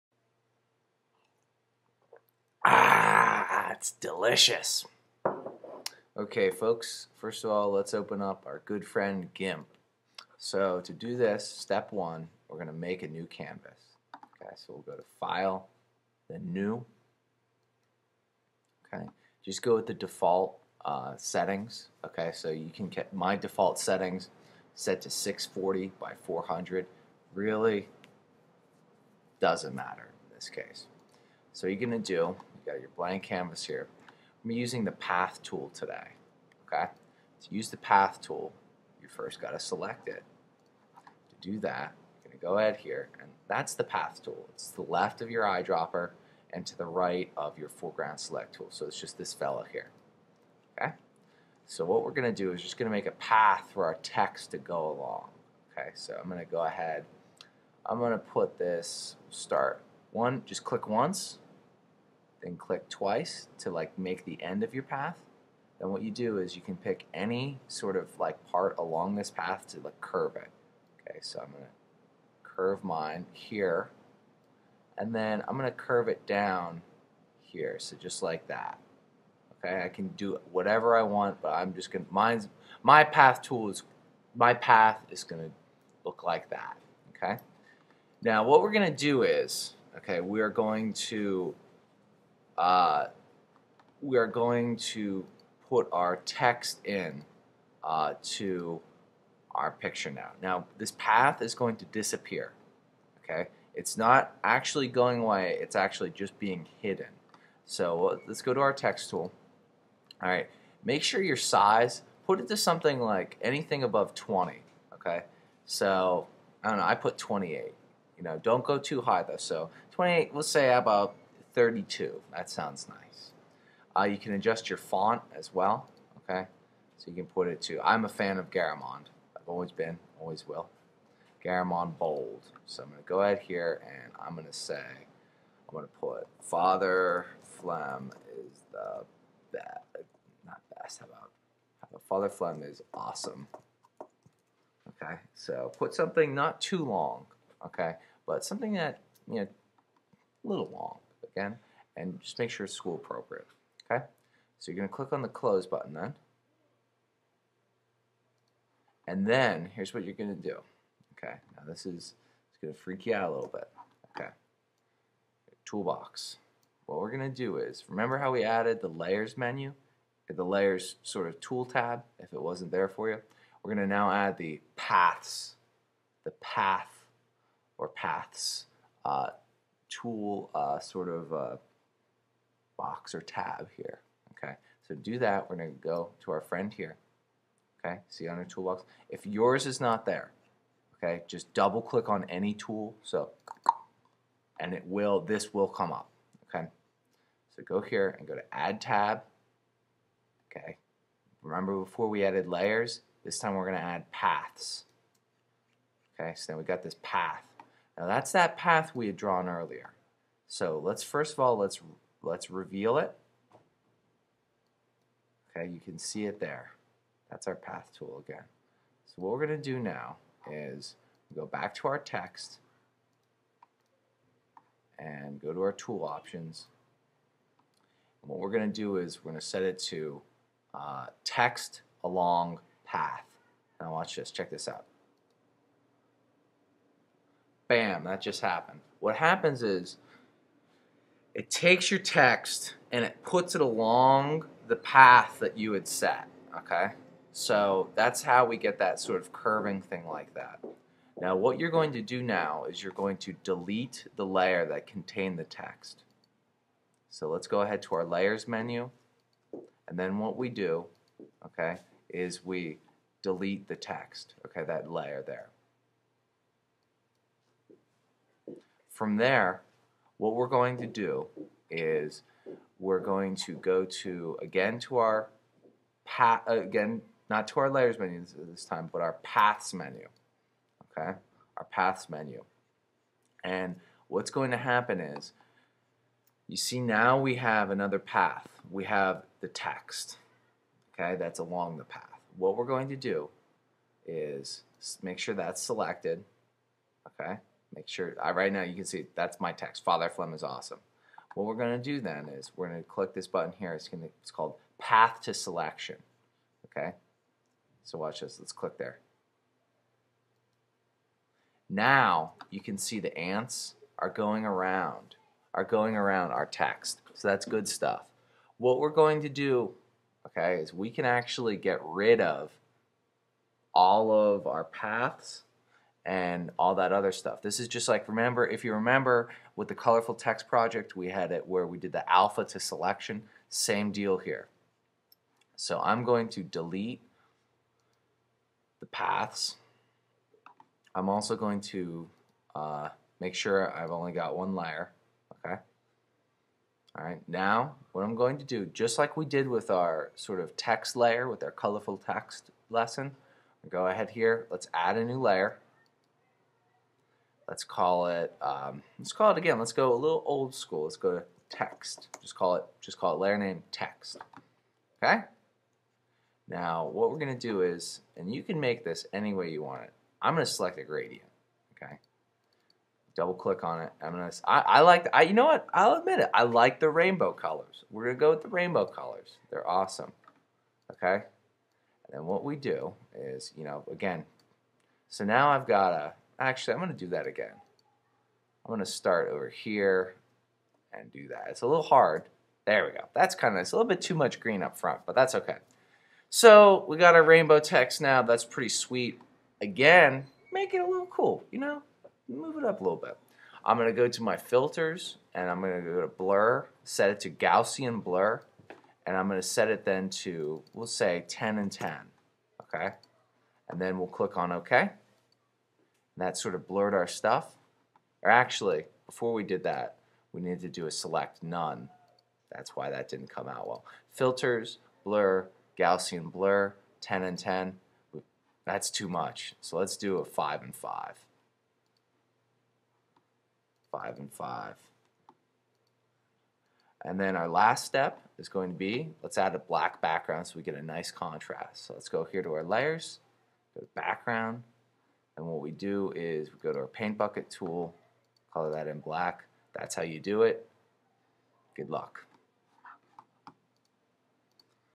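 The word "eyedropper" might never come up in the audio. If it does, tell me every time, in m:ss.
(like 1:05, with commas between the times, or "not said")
0:45.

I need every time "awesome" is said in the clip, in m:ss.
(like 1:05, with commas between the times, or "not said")
2:22, 5:00, 6:19.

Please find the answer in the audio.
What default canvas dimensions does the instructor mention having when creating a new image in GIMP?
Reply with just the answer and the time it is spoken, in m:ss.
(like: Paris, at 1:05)
640 by 400, at 0:25.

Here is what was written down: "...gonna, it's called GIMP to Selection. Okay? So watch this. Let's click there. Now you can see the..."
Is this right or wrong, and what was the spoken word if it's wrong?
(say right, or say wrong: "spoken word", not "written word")
wrong: "Path", not "GIMP".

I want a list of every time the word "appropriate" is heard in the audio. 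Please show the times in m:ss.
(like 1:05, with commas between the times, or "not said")
2:32.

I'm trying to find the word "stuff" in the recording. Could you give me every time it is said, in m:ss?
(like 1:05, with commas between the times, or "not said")
5:17, 5:27, 6:57.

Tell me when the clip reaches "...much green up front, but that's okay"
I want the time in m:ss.
6:34.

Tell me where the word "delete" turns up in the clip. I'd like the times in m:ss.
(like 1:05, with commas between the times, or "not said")
4:13, 4:23, 5:36.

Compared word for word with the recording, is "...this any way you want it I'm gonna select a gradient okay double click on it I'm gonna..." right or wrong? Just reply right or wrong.
right.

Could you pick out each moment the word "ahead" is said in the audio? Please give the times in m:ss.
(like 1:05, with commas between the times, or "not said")
0:42, 0:56, 2:13, 4:17, 5:53.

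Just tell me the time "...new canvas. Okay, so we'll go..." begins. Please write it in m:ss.
0:13.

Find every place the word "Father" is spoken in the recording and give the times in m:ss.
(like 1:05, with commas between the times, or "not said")
2:16, 2:22, 4:59.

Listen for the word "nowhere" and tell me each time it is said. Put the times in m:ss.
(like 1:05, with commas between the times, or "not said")
not said.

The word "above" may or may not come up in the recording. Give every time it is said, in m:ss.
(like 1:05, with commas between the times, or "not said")
1:53.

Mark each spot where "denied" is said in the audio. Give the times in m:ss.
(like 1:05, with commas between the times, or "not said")
not said.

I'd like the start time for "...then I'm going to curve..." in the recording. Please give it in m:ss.
1:15.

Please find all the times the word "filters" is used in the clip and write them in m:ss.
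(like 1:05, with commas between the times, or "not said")
6:44, 7:04.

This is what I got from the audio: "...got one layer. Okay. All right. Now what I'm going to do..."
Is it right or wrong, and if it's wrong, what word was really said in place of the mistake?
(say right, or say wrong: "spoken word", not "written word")
right.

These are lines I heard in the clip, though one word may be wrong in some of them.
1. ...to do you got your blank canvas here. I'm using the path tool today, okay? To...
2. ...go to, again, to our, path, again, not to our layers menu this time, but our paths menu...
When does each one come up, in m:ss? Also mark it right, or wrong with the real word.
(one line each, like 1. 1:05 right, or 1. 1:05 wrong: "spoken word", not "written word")
1. 0:31 right
2. 4:33 right.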